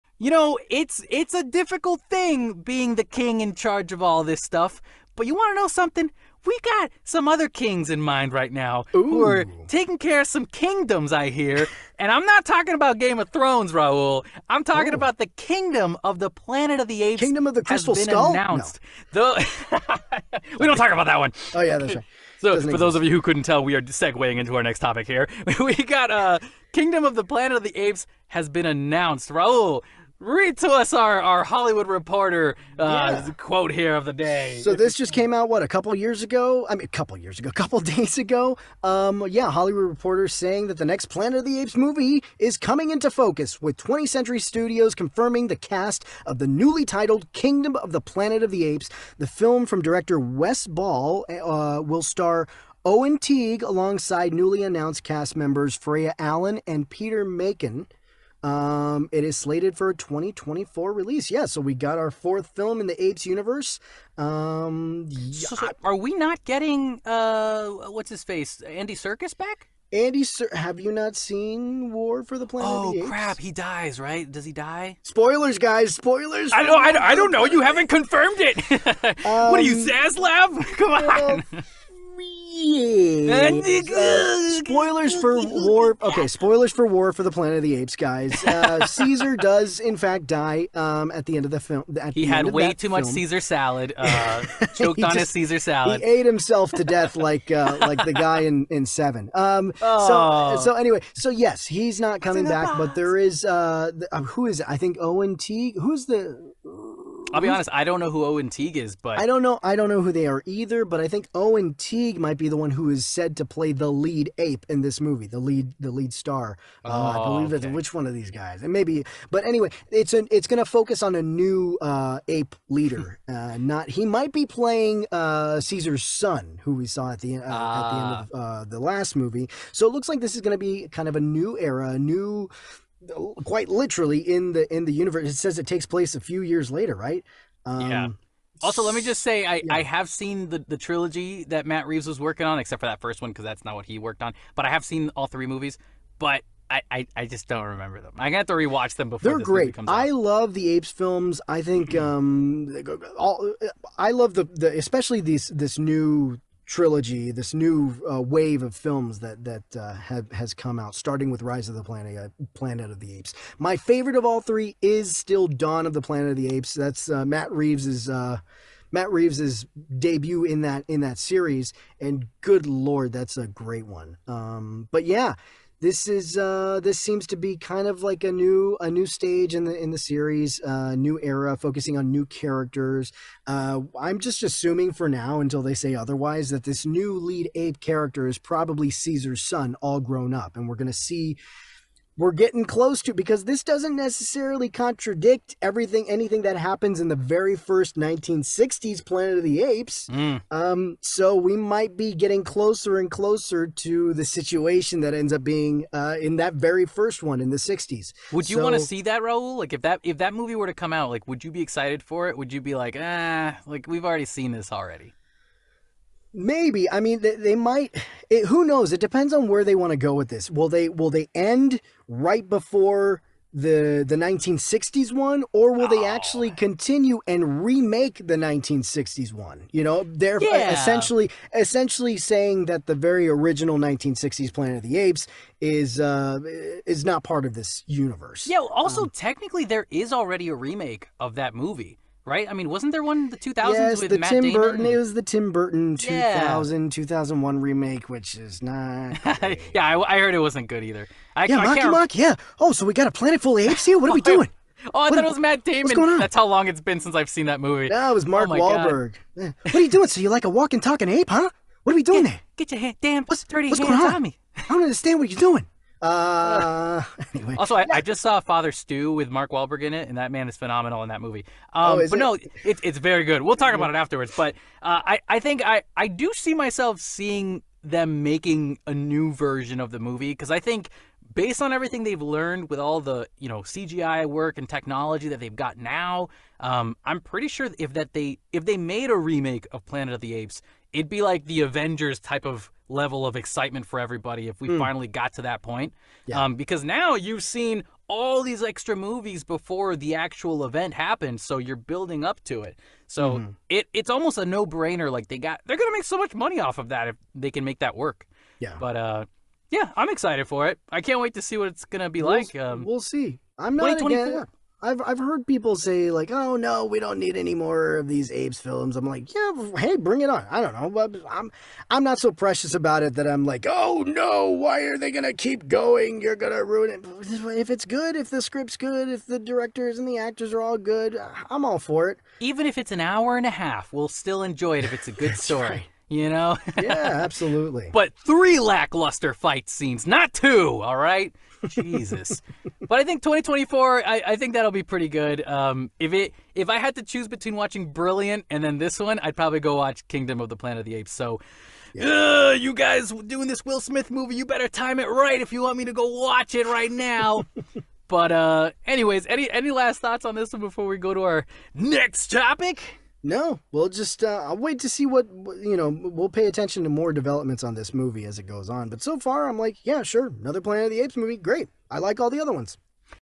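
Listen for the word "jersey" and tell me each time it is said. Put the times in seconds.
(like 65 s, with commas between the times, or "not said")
not said.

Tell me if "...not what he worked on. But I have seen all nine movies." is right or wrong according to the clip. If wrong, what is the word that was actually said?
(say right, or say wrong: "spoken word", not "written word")
wrong: "three", not "nine".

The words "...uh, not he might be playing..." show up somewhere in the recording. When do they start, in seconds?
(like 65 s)
123 s.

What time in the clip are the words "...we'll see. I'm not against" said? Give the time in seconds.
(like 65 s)
312 s.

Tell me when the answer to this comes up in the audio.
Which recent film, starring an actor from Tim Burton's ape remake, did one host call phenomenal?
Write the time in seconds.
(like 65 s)
268 s.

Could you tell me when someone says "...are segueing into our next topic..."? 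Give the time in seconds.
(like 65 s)
23 s.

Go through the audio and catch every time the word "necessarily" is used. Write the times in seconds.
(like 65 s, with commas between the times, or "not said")
193 s.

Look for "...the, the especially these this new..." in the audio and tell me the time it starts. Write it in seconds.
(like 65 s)
154 s.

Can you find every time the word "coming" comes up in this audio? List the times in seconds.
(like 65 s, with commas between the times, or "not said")
42 s, 102 s.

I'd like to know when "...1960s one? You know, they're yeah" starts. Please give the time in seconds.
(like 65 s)
228 s.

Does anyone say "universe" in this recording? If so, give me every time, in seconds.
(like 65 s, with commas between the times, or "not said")
63 s, 134 s, 237 s.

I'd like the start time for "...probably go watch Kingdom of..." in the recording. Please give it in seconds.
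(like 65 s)
349 s.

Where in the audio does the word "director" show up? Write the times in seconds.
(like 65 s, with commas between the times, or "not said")
49 s, 329 s.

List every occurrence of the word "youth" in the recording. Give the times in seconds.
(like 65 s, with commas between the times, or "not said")
not said.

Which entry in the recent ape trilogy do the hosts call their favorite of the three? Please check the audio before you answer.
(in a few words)
Dawn of the Planet of the Apes.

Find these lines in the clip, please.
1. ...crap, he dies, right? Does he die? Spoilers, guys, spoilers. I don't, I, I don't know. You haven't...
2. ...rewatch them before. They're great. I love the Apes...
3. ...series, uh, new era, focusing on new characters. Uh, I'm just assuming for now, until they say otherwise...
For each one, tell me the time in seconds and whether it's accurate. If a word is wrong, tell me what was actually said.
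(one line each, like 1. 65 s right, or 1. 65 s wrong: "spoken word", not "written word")
1. 73 s right
2. 148 s right
3. 179 s right.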